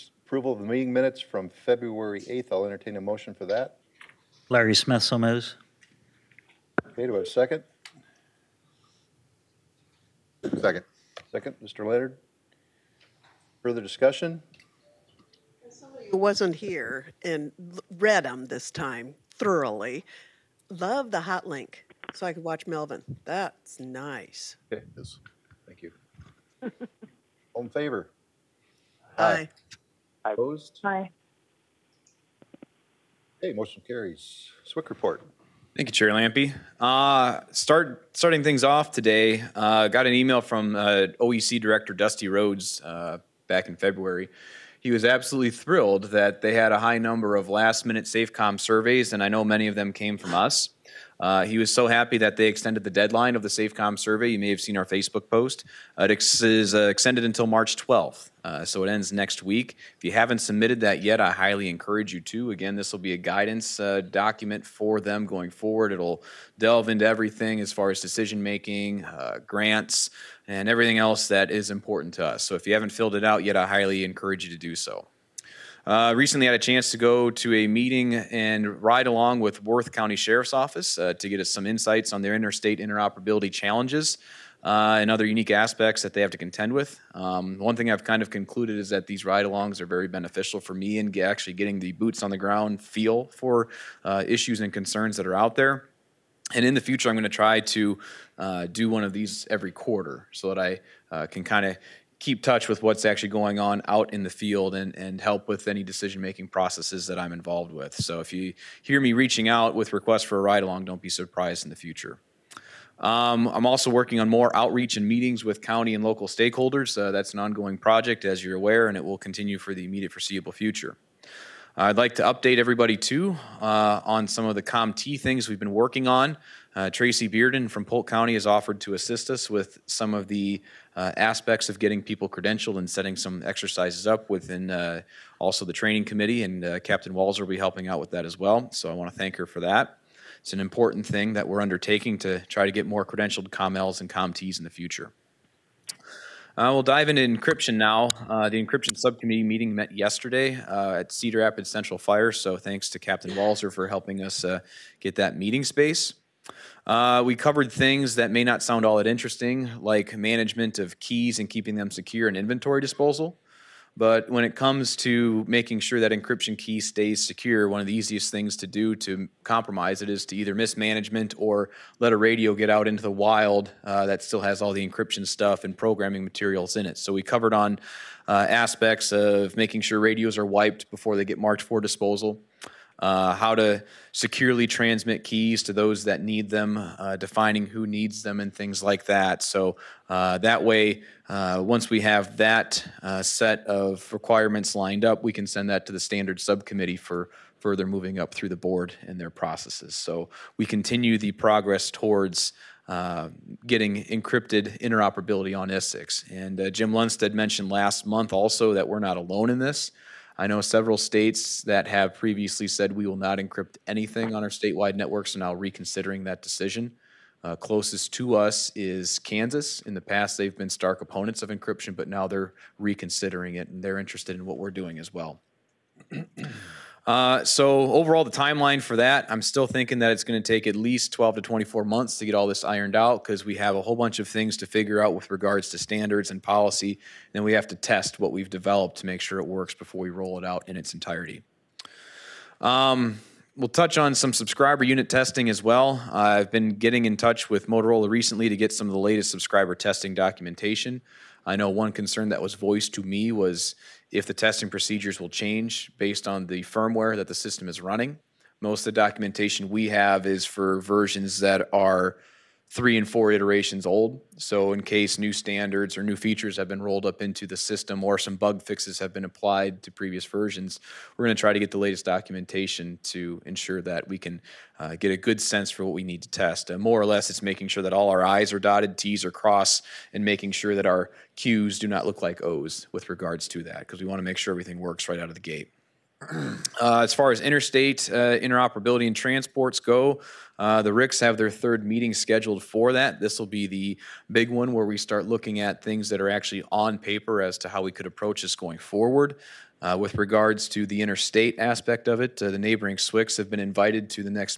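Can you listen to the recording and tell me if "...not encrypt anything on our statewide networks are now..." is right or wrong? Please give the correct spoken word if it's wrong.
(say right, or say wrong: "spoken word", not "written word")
right.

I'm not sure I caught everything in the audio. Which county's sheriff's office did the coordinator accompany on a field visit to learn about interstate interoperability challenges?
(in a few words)
Worth County.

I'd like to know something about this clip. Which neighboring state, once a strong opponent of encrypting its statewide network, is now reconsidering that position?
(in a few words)
Kansas.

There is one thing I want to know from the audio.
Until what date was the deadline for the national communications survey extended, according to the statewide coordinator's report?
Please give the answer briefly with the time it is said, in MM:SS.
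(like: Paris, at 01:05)
March 12th, at 00:57.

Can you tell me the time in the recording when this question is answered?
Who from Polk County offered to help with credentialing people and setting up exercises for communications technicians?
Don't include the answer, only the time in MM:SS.
02:06.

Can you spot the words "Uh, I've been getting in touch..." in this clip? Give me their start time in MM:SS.
04:06.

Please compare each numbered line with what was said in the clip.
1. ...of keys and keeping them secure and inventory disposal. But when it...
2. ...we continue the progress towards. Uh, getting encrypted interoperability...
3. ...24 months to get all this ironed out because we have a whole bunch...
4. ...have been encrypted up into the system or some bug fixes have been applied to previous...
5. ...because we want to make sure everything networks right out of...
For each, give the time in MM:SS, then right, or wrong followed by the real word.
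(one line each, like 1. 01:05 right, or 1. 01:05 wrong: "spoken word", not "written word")
1. 02:40 right
2. 03:20 right
3. 03:51 right
4. 04:26 wrong: "rolled", not "encrypted"
5. 04:43 wrong: "works", not "networks".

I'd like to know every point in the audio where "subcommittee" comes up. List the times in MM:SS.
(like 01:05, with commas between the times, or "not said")
02:28, 03:16.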